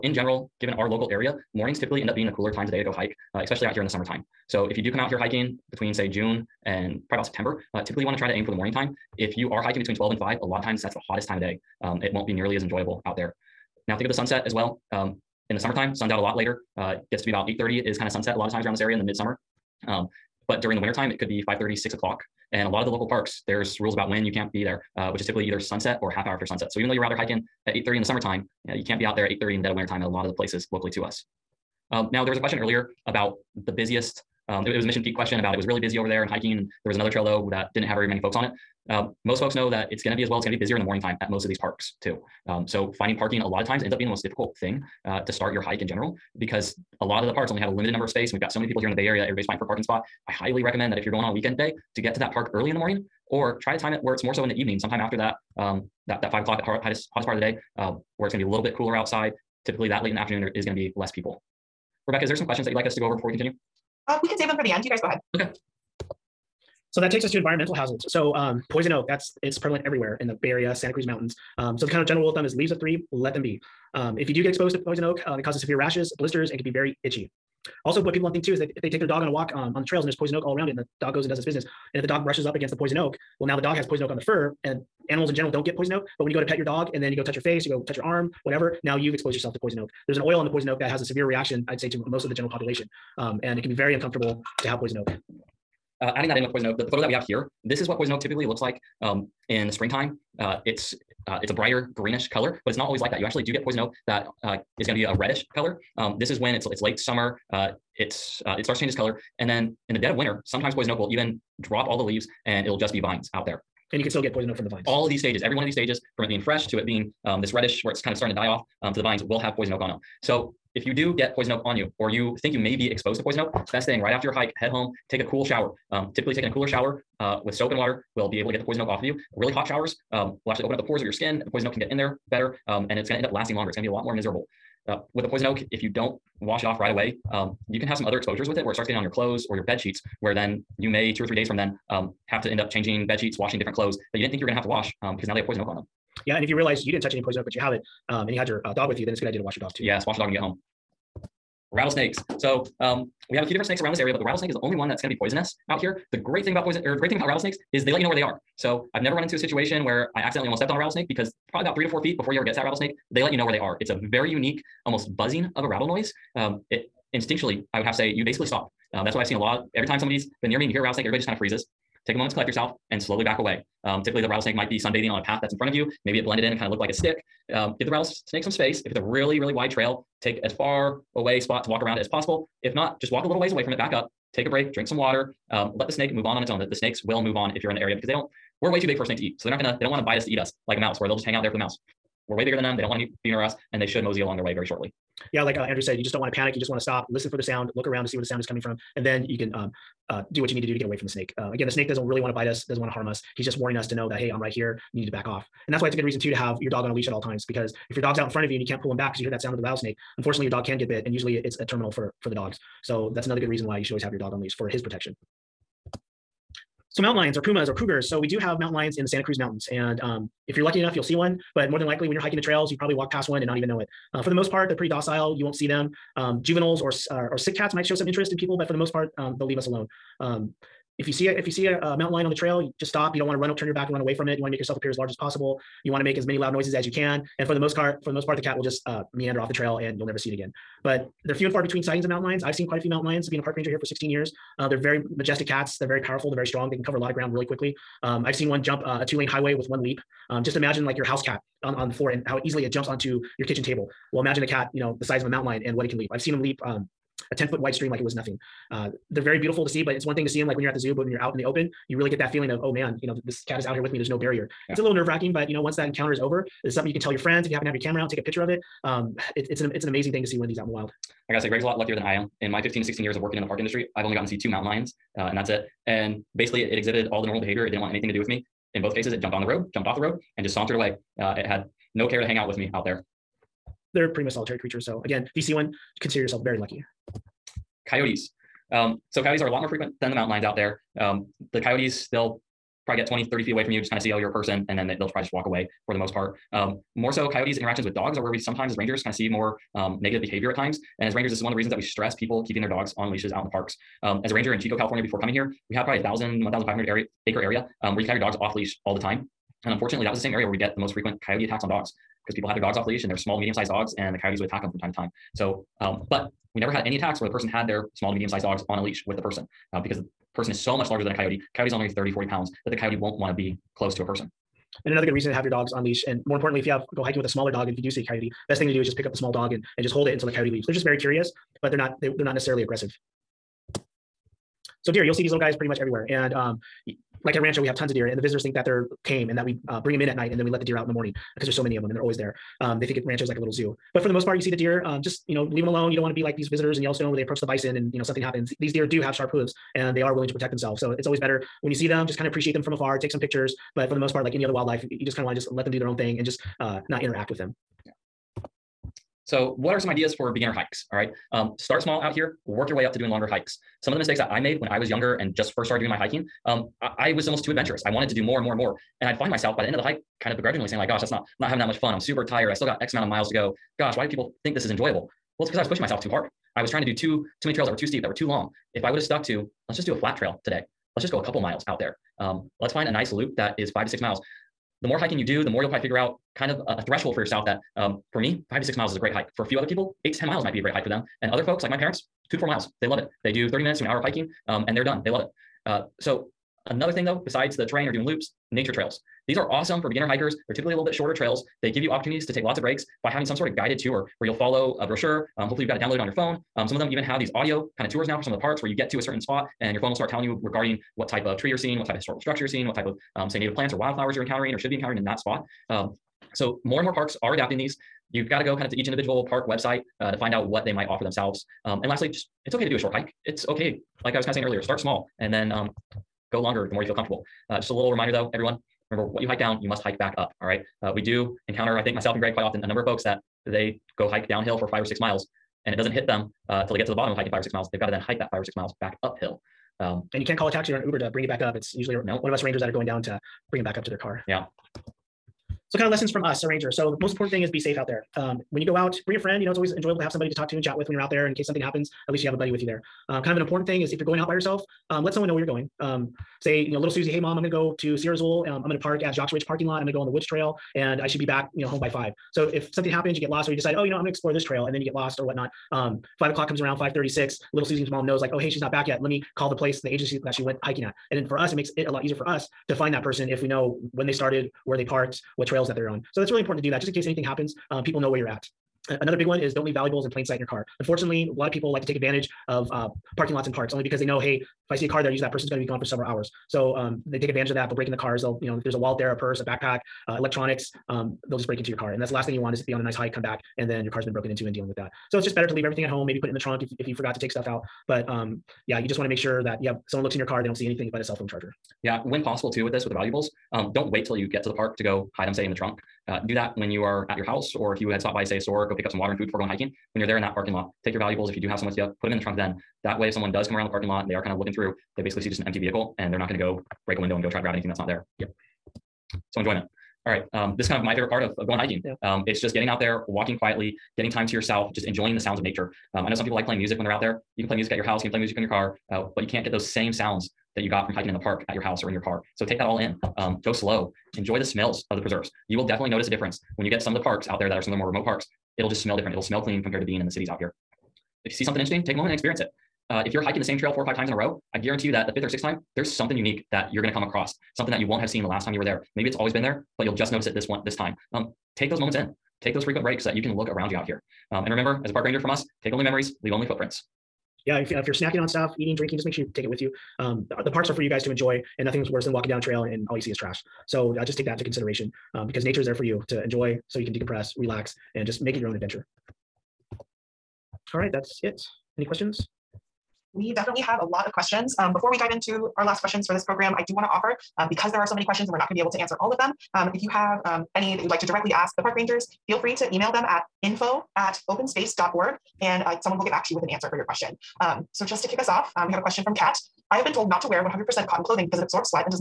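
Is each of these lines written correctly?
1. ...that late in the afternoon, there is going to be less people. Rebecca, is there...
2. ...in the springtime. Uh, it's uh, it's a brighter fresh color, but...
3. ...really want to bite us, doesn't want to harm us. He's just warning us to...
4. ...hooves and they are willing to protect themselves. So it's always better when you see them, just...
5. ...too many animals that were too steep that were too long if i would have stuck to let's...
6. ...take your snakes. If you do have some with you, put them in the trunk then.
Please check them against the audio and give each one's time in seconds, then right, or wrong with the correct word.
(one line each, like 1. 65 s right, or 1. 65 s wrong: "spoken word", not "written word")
1. 59 s right
2. 99 s wrong: "greenish", not "fresh"
3. 202 s right
4. 349 s right
5. 377 s wrong: "trails", not "animals"
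6. 510 s wrong: "valuables", not "snakes".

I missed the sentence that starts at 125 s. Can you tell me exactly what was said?
Um, typically, taking a cooler shower uh, with soap and water will be able to get the poison oak off of you.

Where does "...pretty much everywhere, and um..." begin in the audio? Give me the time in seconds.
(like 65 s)
335 s.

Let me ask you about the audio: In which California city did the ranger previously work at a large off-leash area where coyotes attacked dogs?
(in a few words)
Chico.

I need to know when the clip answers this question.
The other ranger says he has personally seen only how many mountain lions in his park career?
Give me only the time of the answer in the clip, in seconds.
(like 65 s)
274 s.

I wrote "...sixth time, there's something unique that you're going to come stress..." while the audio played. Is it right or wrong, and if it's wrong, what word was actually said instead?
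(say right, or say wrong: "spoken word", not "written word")
wrong: "across", not "stress".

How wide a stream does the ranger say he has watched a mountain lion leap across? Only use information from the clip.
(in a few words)
10 feet.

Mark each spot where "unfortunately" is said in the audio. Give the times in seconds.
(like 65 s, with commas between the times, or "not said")
210 s, 309 s, 480 s.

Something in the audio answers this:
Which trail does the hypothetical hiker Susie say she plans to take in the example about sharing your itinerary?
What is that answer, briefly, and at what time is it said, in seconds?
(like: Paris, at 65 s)
Woods Trail, at 460 s.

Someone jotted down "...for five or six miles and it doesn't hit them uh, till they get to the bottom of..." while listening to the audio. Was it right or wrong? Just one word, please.
right.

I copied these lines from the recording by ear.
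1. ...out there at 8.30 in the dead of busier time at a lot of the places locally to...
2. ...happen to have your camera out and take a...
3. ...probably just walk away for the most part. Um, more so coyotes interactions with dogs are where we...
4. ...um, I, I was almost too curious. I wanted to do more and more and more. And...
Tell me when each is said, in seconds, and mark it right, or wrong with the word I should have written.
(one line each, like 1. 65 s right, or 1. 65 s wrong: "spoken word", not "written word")
1. 29 s wrong: "winter", not "busier"
2. 267 s right
3. 295 s right
4. 366 s wrong: "adventurous", not "curious".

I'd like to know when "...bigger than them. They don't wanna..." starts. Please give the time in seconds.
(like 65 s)
192 s.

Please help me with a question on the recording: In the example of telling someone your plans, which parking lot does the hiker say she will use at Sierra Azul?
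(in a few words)
Jacques Ridge.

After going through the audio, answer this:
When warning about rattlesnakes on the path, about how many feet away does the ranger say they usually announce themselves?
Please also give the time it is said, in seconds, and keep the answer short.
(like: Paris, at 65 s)
3 to 4 feet, at 161 s.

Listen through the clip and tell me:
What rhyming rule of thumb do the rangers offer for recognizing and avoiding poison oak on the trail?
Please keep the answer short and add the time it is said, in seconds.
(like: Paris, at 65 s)
Leaves of three, let them be, at 72 s.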